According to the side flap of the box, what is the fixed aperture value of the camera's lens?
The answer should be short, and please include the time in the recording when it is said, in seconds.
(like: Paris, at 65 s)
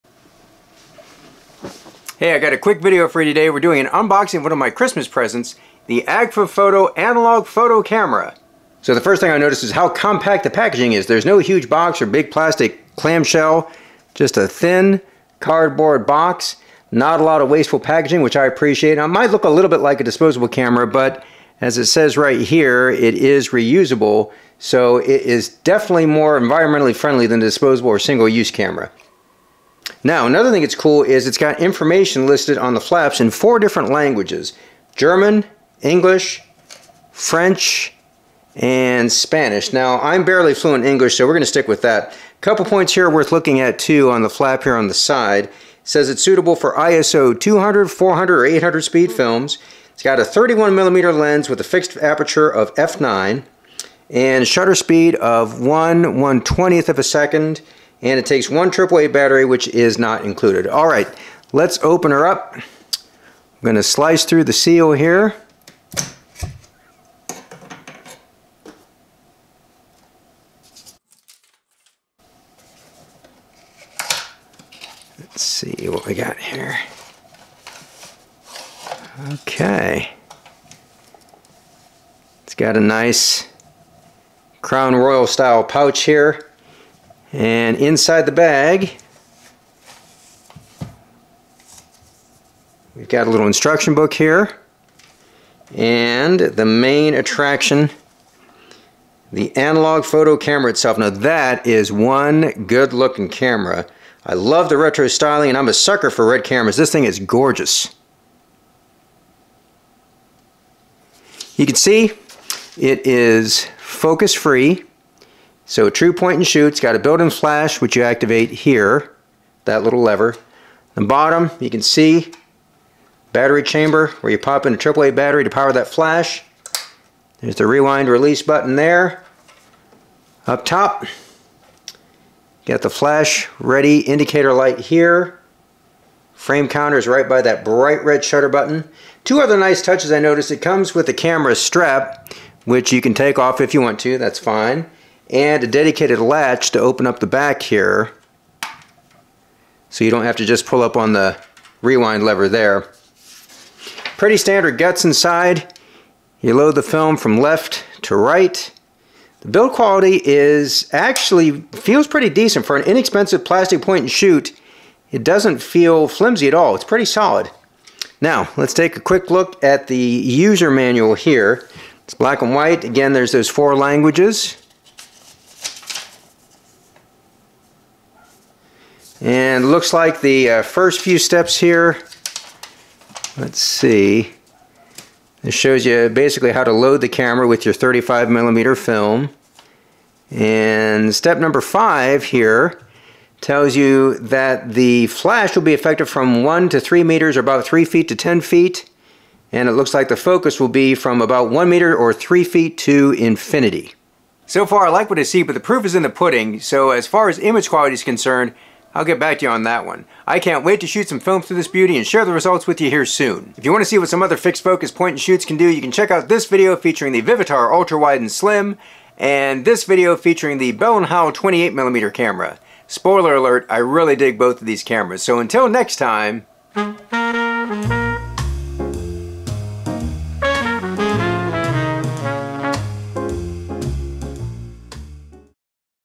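f9, at 52 s.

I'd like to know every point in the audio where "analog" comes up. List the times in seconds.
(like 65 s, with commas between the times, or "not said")
6 s, 99 s.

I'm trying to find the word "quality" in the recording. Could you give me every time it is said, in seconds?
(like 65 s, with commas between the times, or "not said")
159 s, 207 s.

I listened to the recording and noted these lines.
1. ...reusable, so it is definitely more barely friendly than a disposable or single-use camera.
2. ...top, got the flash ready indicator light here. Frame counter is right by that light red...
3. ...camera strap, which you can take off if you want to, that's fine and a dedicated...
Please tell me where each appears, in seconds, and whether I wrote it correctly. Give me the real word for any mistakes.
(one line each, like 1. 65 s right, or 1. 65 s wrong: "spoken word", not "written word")
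1. 23 s wrong: "environmentally", not "barely"
2. 130 s wrong: "bright", not "light"
3. 141 s right.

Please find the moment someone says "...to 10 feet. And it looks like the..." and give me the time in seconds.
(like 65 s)
198 s.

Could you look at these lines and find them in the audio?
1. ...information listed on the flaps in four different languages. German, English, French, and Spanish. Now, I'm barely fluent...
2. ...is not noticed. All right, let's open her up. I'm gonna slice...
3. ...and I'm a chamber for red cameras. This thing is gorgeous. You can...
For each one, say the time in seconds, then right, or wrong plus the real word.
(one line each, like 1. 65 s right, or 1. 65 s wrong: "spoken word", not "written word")
1. 31 s right
2. 59 s wrong: "included", not "noticed"
3. 105 s wrong: "sucker", not "chamber".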